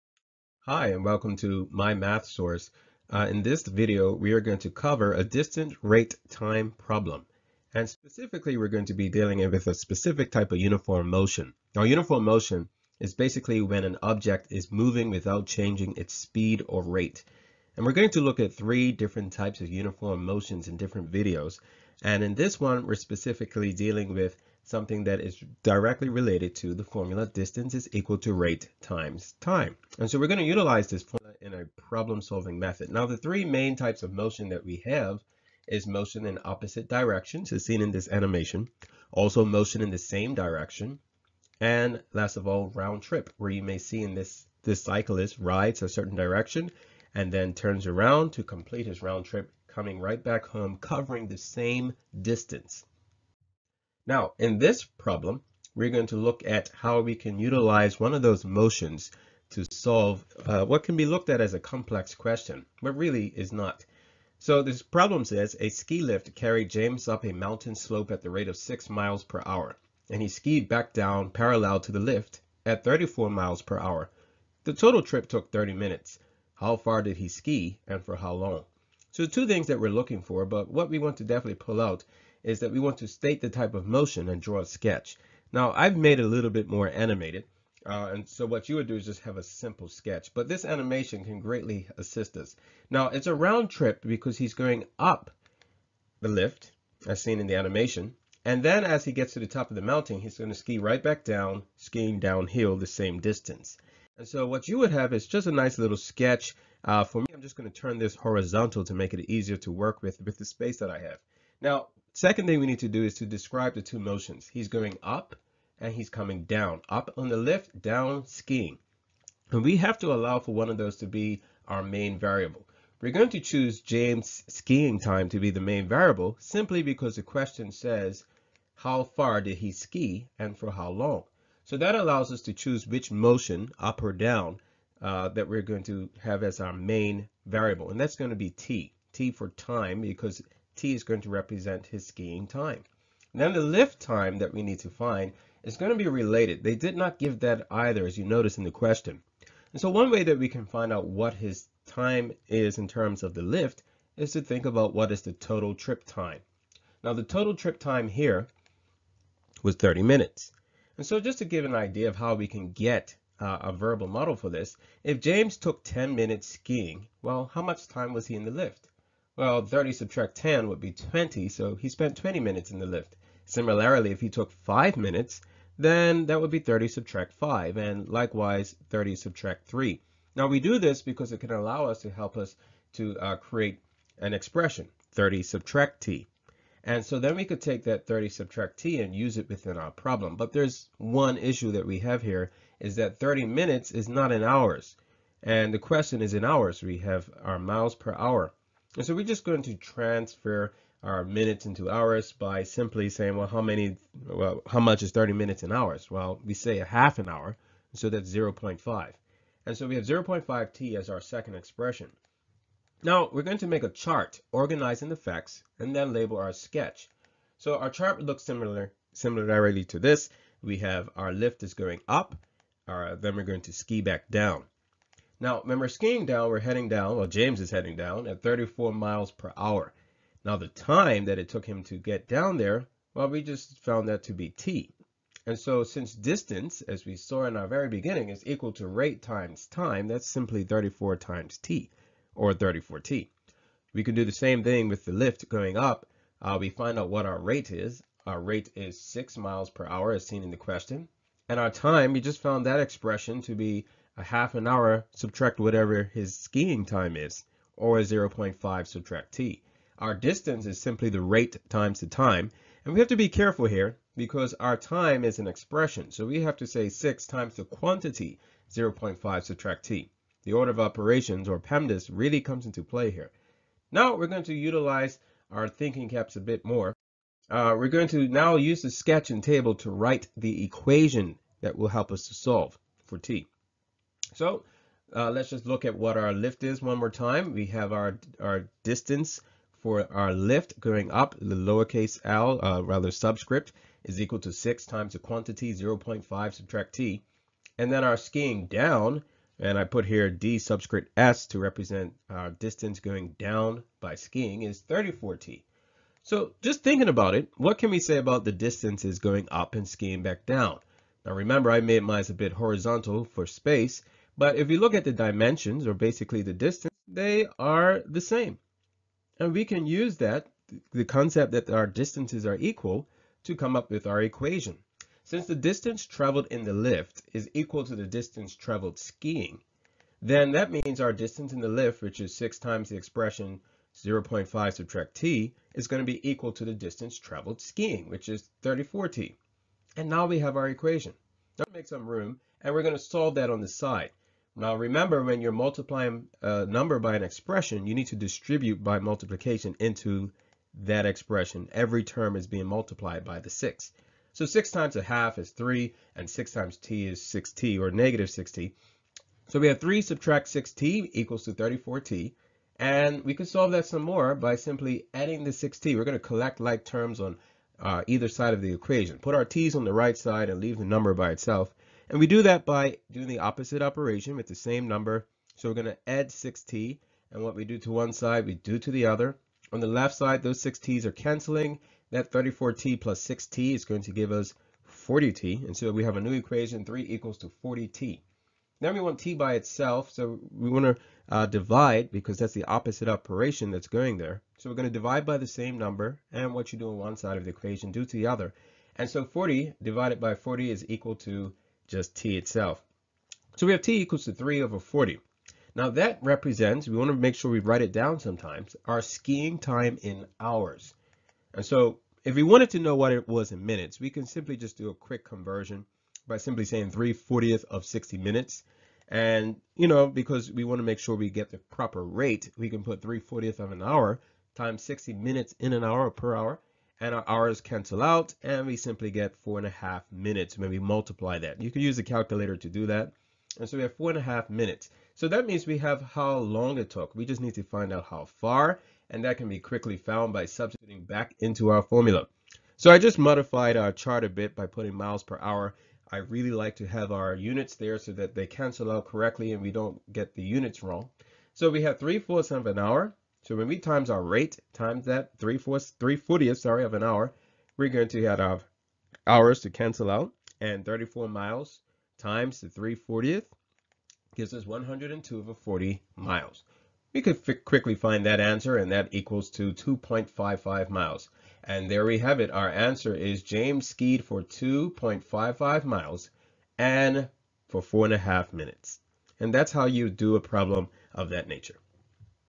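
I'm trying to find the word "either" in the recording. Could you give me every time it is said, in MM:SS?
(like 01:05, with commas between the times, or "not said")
02:27, 06:08.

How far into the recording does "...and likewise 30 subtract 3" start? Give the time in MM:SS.
02:57.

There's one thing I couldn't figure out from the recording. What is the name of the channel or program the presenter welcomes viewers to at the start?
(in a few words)
My Math Source.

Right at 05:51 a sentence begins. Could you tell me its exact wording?
Every term is being multiplied by the 6.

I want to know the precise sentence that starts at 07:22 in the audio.
So I just modified our chart a bit by putting miles per hour.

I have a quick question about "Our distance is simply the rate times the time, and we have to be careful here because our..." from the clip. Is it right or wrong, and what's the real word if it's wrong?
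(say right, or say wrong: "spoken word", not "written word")
right.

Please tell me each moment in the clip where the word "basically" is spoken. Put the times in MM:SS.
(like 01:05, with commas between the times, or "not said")
00:13, 05:15.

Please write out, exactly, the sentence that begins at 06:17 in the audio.
And what we do to one side, we do to the other.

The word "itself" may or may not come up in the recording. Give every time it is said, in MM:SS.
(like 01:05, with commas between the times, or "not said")
06:11, 06:29, 06:42.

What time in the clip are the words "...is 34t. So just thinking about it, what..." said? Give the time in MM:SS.
05:04.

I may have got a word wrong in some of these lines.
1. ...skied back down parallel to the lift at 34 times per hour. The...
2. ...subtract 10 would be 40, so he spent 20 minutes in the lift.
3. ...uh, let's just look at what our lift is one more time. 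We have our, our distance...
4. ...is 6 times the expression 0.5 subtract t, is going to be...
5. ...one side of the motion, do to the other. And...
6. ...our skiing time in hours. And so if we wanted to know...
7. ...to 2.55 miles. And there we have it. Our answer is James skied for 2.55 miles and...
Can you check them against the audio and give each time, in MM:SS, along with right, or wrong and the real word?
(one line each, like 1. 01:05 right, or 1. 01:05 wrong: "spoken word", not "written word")
1. 01:10 wrong: "miles", not "times"
2. 02:49 wrong: "20", not "40"
3. 04:45 right
4. 05:32 right
5. 06:36 wrong: "equation", not "motion"
6. 06:48 right
7. 07:49 right.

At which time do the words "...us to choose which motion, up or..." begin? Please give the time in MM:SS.
02:12.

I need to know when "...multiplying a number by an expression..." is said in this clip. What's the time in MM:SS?
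05:45.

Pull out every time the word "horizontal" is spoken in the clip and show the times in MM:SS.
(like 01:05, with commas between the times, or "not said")
01:48, 05:12.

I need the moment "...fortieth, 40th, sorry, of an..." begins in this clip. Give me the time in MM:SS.
07:36.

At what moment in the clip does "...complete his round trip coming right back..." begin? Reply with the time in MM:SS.
00:48.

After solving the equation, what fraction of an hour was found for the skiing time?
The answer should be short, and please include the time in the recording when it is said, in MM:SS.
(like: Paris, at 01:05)
3/40, at 06:44.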